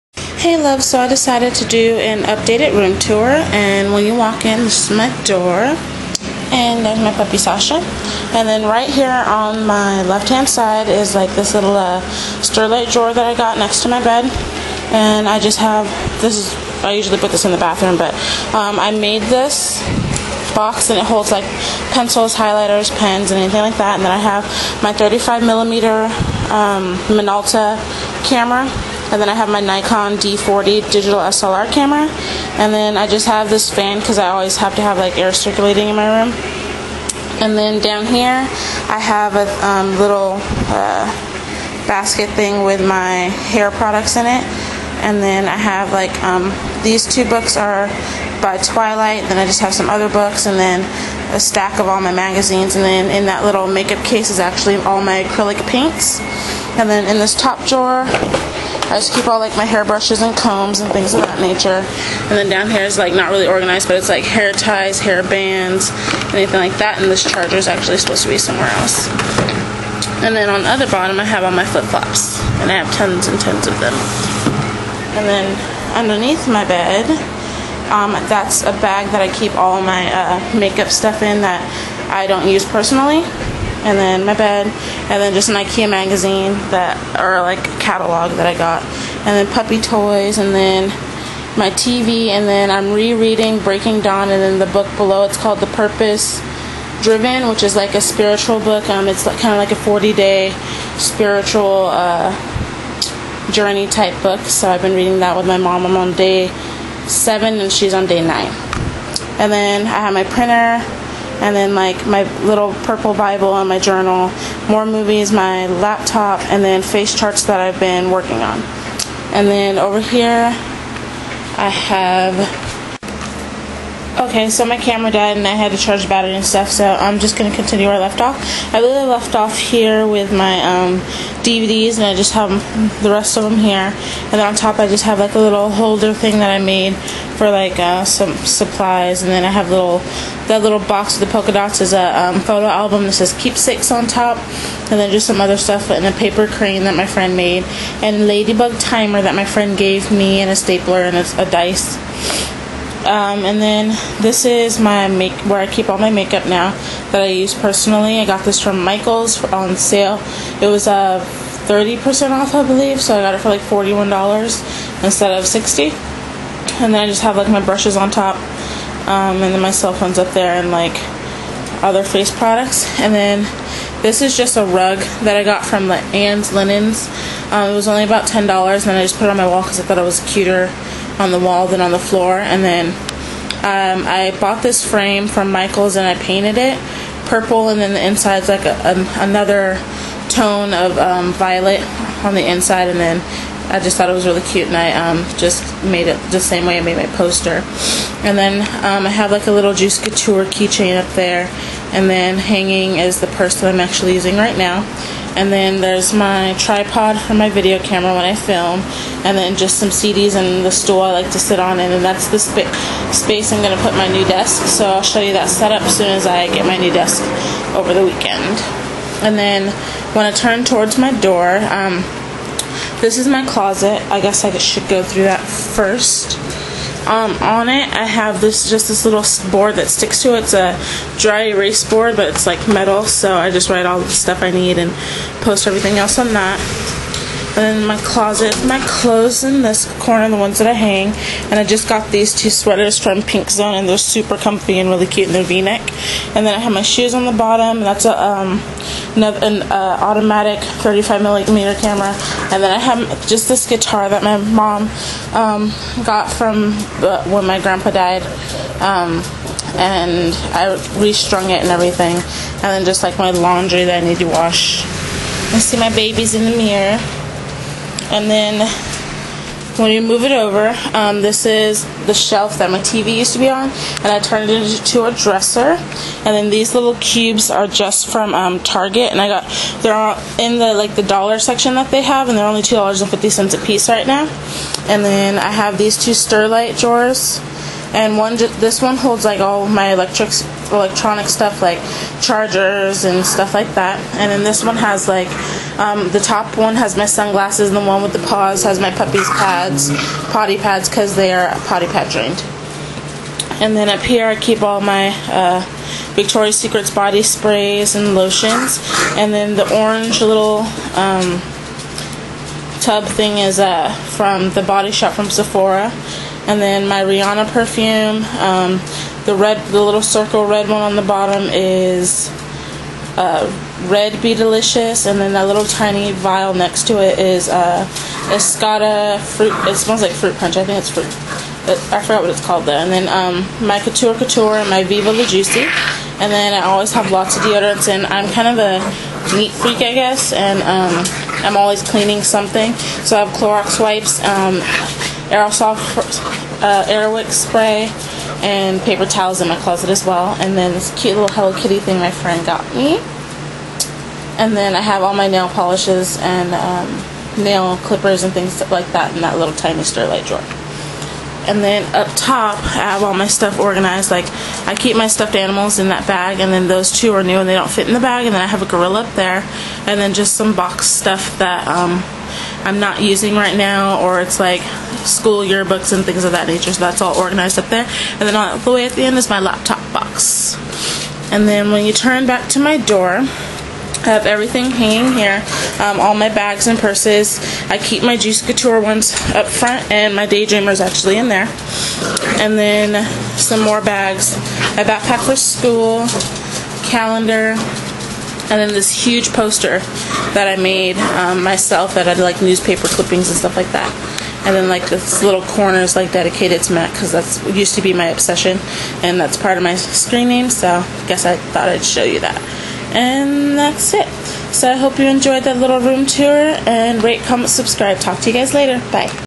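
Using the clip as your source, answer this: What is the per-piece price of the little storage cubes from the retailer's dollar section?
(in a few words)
$2.50.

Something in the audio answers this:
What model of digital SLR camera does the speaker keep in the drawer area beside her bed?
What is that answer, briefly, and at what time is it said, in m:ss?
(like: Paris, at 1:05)
Nikon D40, at 0:29.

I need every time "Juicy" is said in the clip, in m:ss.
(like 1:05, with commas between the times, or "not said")
3:19, 5:35, 6:28.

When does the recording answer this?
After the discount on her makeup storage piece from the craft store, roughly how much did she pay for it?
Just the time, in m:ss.
2:43.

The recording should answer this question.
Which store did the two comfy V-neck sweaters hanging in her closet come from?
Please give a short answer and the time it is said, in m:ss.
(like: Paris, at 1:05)
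Pink Zone, at 4:03.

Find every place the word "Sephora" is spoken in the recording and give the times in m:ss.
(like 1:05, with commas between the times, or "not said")
5:15.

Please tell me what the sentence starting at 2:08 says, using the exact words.
I really left off here with my um, DVDs, and I just have the rest of them here.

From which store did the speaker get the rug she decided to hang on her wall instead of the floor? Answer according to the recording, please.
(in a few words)
Anna's Linens.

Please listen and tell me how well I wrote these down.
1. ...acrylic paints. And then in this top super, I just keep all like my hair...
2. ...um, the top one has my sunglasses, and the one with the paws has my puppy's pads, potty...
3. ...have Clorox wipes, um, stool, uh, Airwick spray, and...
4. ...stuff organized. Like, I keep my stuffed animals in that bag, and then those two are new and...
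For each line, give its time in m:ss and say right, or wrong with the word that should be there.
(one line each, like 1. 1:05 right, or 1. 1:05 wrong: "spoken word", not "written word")
1. 0:55 wrong: "drawer", not "super"
2. 4:55 right
3. 5:43 wrong: "aerosol", not "stool"
4. 6:03 right.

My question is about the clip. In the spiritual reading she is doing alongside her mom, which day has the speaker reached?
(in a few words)
Day 7.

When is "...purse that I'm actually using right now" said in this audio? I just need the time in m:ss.
3:23.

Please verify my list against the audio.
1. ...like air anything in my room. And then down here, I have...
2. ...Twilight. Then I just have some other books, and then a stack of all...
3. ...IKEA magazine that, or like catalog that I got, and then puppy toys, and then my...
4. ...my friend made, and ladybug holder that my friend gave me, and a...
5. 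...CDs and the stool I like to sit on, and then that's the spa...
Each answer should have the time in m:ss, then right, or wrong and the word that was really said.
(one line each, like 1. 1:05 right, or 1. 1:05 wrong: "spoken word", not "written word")
1. 0:34 wrong: "circulating", not "anything"
2. 0:48 right
3. 1:25 right
4. 2:26 wrong: "timer", not "holder"
5. 3:29 right.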